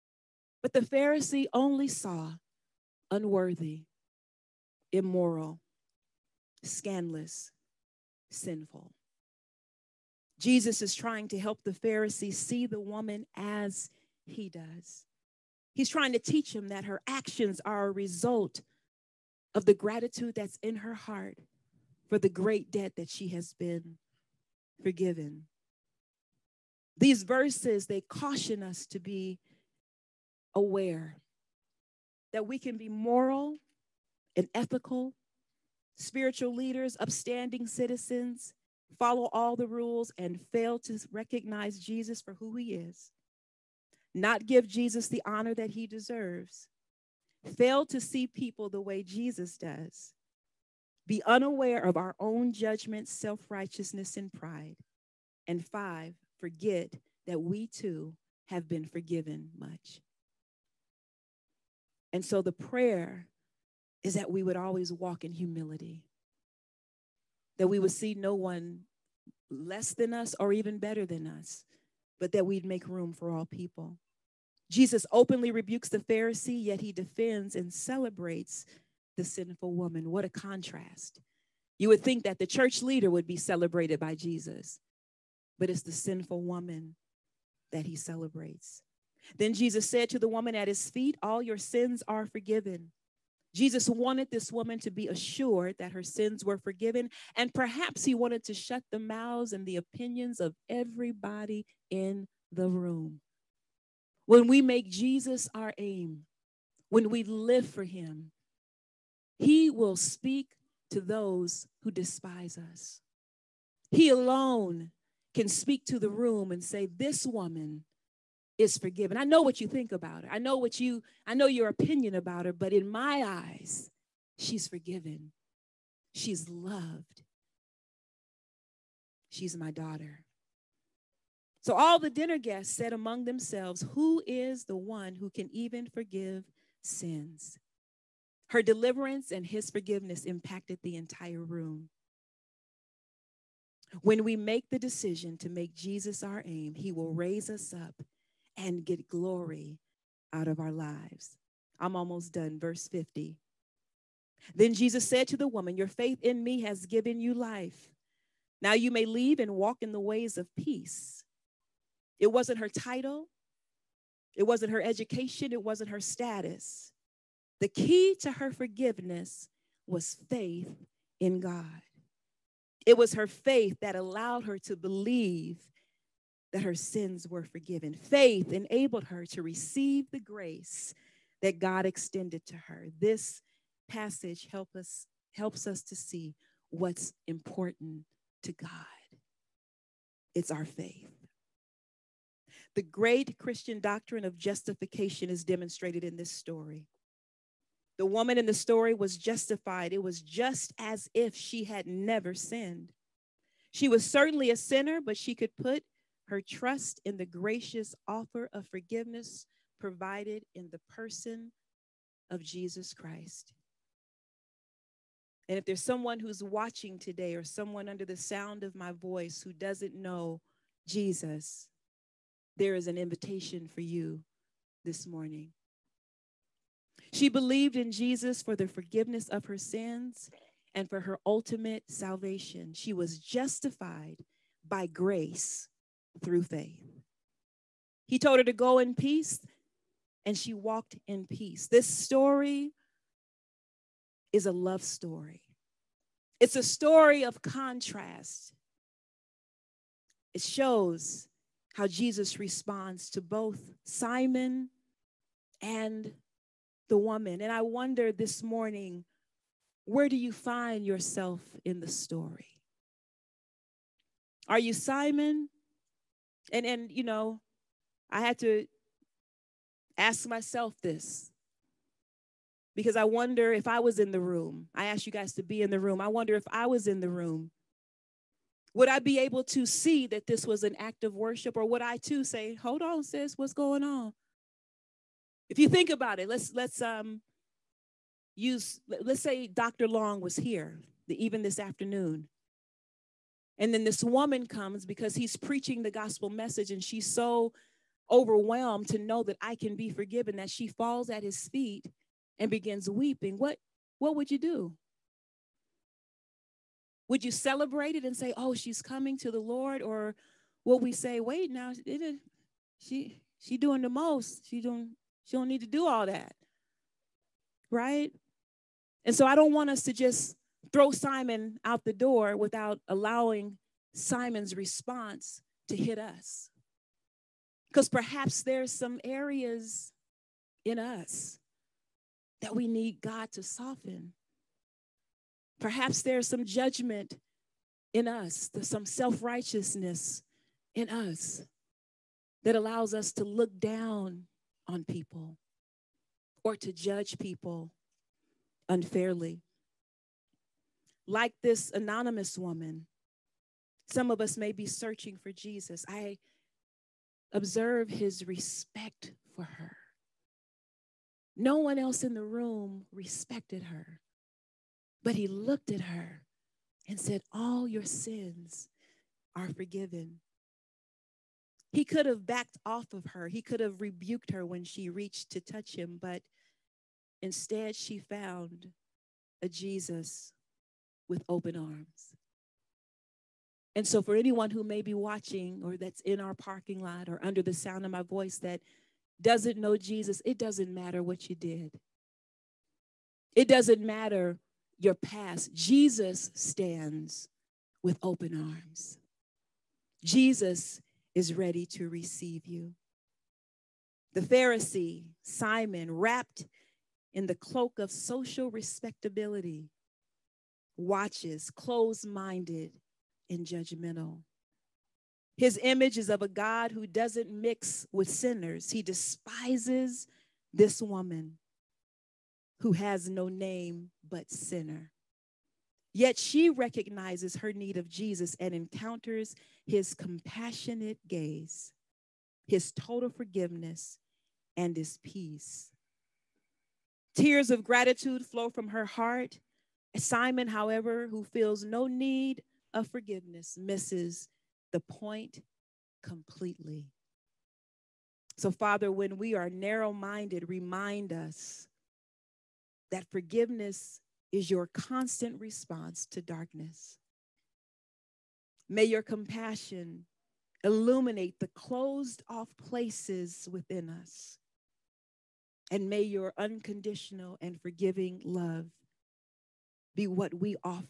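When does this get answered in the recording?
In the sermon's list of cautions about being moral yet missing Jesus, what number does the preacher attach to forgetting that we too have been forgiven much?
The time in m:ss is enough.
0:55.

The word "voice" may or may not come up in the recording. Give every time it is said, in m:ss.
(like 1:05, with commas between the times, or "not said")
3:38, 6:28.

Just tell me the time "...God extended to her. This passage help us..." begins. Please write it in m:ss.
3:01.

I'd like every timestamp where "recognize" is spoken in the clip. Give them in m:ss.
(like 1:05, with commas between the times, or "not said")
0:41, 7:06.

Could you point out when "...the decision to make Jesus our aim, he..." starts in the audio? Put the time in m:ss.
2:24.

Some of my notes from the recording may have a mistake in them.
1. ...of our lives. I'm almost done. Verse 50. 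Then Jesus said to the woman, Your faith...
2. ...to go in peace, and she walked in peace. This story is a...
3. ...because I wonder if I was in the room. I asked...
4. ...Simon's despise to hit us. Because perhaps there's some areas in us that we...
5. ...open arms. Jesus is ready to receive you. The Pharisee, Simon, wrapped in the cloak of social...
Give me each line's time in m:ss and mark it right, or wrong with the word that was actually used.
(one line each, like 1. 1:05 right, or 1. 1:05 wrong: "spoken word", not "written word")
1. 2:30 right
2. 3:58 right
3. 4:32 right
4. 5:23 wrong: "response", not "despise"
5. 6:37 right.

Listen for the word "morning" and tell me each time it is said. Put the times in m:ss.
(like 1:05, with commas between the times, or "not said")
3:45, 4:18.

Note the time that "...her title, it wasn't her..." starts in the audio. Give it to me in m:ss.
2:42.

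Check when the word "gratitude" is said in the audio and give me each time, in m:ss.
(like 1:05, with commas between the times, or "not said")
0:19, 7:17.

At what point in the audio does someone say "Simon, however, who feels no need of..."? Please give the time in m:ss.
7:19.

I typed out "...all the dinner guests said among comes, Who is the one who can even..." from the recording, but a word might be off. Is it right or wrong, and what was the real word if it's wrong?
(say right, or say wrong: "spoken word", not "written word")
wrong: "themselves", not "comes".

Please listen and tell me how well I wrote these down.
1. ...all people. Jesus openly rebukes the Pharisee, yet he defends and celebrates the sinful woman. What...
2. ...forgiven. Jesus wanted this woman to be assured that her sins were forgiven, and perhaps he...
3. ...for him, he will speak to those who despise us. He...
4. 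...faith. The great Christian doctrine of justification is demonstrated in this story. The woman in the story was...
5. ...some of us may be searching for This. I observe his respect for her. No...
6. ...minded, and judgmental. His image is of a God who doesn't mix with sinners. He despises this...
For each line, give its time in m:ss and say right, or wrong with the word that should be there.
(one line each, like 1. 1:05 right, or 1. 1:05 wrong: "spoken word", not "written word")
1. 1:13 right
2. 1:32 right
3. 1:47 right
4. 3:10 right
5. 5:53 wrong: "Jesus", not "This"
6. 6:52 right.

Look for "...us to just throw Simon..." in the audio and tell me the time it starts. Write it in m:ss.
5:19.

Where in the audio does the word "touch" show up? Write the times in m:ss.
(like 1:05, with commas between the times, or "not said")
6:15.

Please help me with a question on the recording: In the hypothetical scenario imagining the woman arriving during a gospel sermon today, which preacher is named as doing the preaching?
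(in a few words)
Dr. Long.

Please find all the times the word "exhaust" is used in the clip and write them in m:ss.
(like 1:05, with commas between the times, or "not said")
not said.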